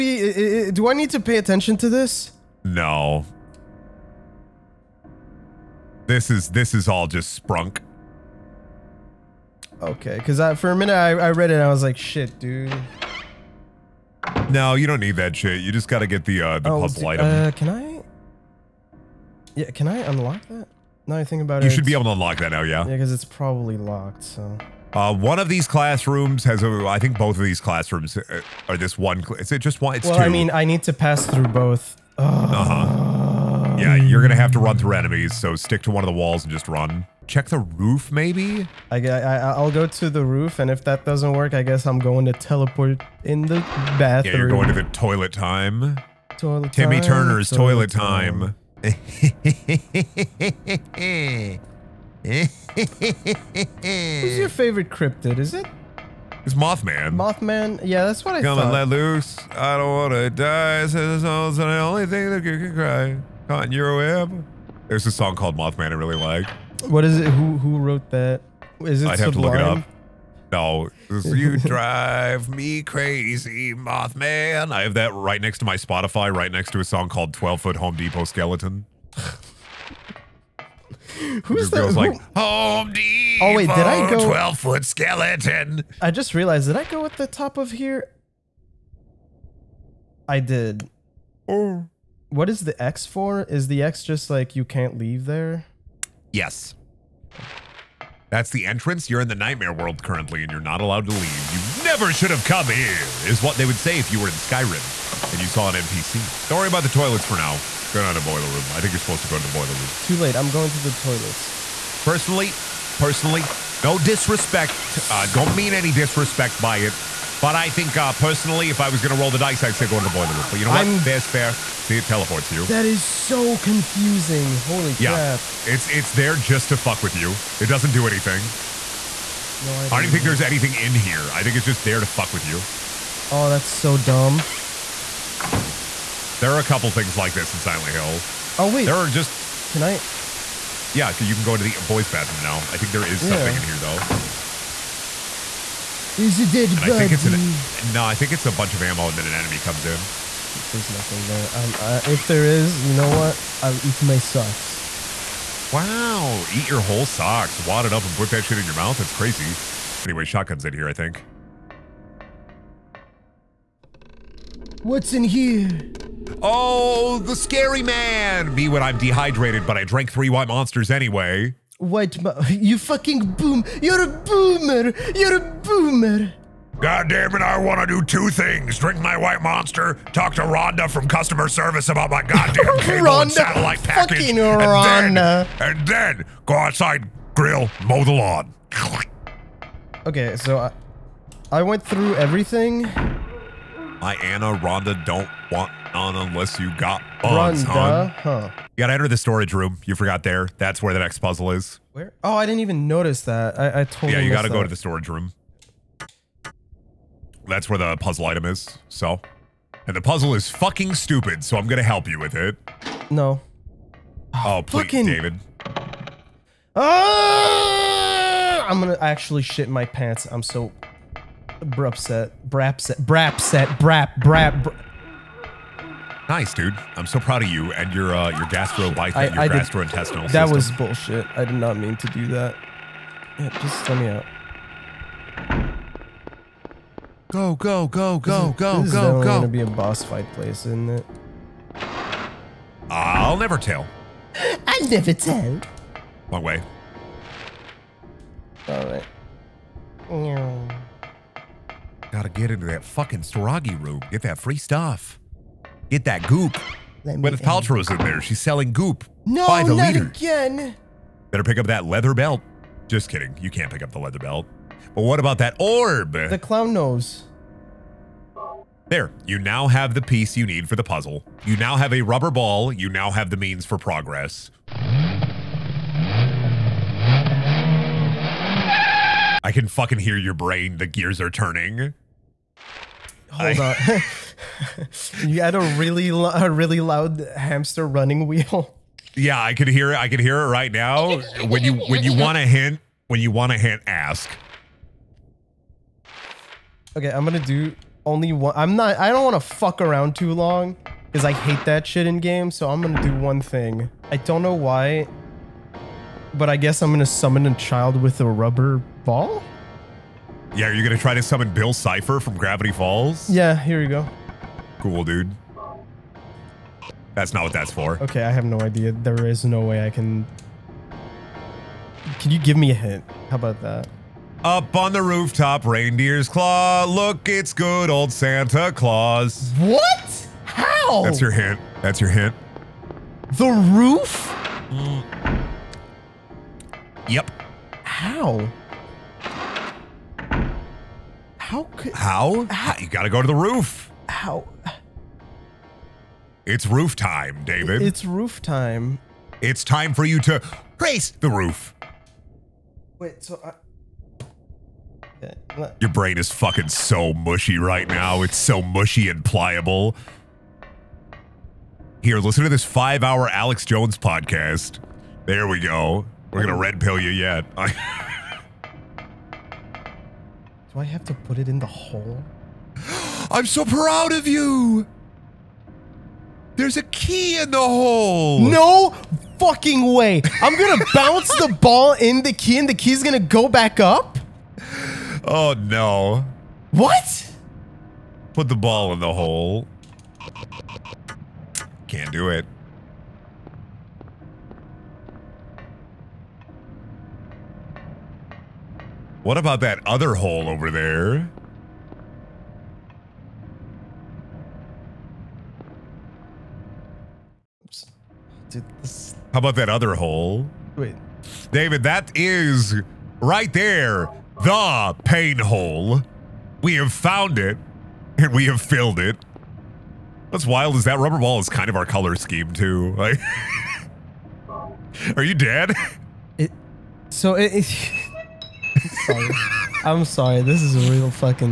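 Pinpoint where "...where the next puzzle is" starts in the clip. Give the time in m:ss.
3:20.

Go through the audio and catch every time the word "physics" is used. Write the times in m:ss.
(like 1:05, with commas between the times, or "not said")
not said.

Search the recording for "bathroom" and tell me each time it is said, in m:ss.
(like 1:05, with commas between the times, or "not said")
0:43, 2:22.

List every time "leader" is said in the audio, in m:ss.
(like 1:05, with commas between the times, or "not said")
4:19.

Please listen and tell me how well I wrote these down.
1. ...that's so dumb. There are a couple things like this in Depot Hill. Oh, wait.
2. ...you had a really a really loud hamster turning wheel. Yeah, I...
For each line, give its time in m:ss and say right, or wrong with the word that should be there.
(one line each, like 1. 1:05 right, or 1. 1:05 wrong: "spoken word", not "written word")
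1. 2:13 wrong: "Silent", not "Depot"
2. 4:45 wrong: "running", not "turning".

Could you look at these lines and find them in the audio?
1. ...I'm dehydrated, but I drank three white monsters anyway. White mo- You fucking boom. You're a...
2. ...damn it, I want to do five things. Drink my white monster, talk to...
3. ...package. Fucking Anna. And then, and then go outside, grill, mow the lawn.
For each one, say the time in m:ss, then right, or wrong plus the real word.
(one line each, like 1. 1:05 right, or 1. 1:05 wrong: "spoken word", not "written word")
1. 2:48 right
2. 2:57 wrong: "two", not "five"
3. 3:03 wrong: "Rhonda", not "Anna".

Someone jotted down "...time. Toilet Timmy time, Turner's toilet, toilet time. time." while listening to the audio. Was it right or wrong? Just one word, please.
right.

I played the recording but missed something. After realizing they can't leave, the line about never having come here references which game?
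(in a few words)
Skyrim.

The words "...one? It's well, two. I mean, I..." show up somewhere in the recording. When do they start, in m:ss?
0:29.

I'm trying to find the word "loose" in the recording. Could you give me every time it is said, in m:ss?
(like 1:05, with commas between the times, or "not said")
0:58.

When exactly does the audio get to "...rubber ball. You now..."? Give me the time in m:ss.
4:32.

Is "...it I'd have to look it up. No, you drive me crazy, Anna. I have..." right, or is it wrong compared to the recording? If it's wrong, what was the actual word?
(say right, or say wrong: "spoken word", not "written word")
wrong: "Mothman", not "Anna".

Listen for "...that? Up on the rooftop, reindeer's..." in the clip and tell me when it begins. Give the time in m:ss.
5:23.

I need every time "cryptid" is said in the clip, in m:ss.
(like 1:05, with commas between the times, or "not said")
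0:54.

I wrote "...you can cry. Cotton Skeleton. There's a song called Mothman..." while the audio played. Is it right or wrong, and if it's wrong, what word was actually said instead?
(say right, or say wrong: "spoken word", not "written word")
wrong: "Euroab", not "Skeleton".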